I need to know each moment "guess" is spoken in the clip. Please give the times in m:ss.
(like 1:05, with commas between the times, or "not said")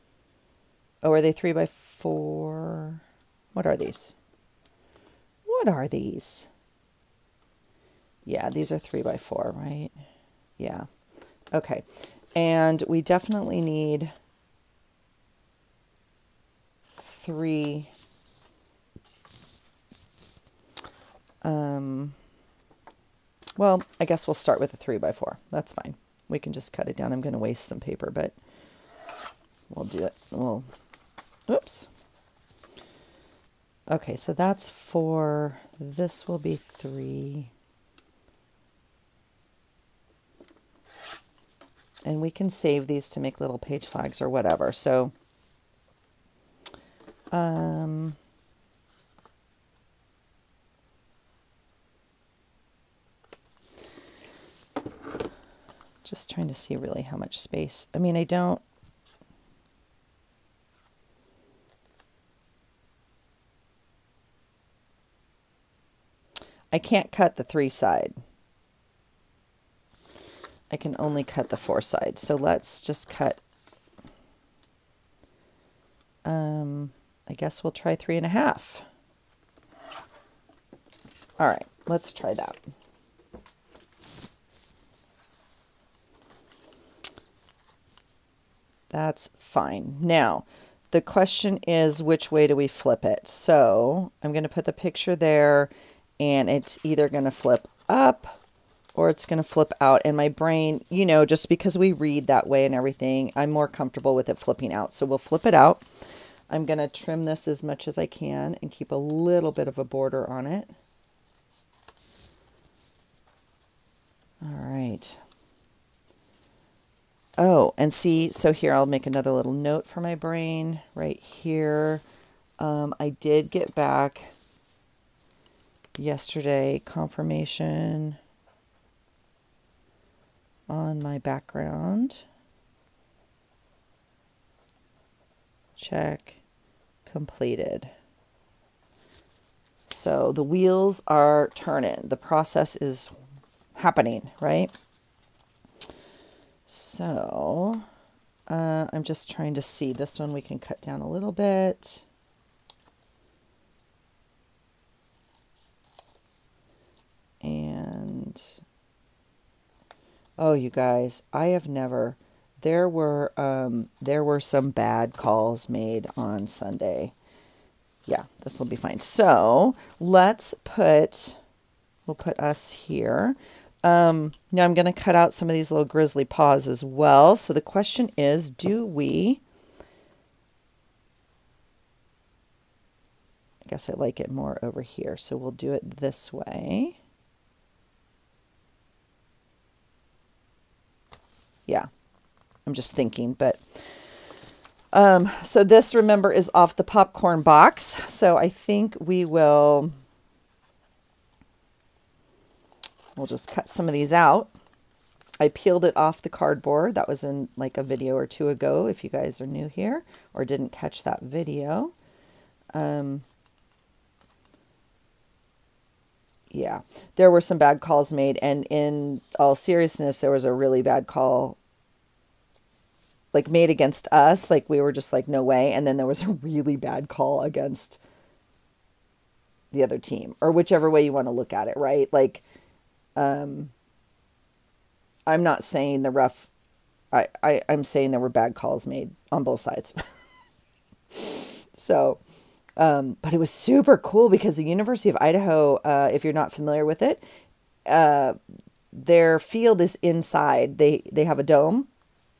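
0:24, 1:17, 3:03.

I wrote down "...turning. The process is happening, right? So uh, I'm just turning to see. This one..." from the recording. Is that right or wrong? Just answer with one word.
wrong.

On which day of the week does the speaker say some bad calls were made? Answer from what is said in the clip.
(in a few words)
Sunday.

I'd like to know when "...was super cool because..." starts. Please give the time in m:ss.
4:03.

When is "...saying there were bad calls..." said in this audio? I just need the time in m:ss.
3:57.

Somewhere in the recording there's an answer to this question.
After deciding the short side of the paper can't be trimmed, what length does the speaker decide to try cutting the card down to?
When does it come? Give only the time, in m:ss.
1:17.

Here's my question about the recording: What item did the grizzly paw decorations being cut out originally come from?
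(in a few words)
popcorn box.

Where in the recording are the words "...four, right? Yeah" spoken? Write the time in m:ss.
0:09.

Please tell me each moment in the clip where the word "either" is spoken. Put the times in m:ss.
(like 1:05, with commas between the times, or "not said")
1:36.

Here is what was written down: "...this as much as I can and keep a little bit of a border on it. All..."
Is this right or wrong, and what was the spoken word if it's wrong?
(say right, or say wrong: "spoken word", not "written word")
right.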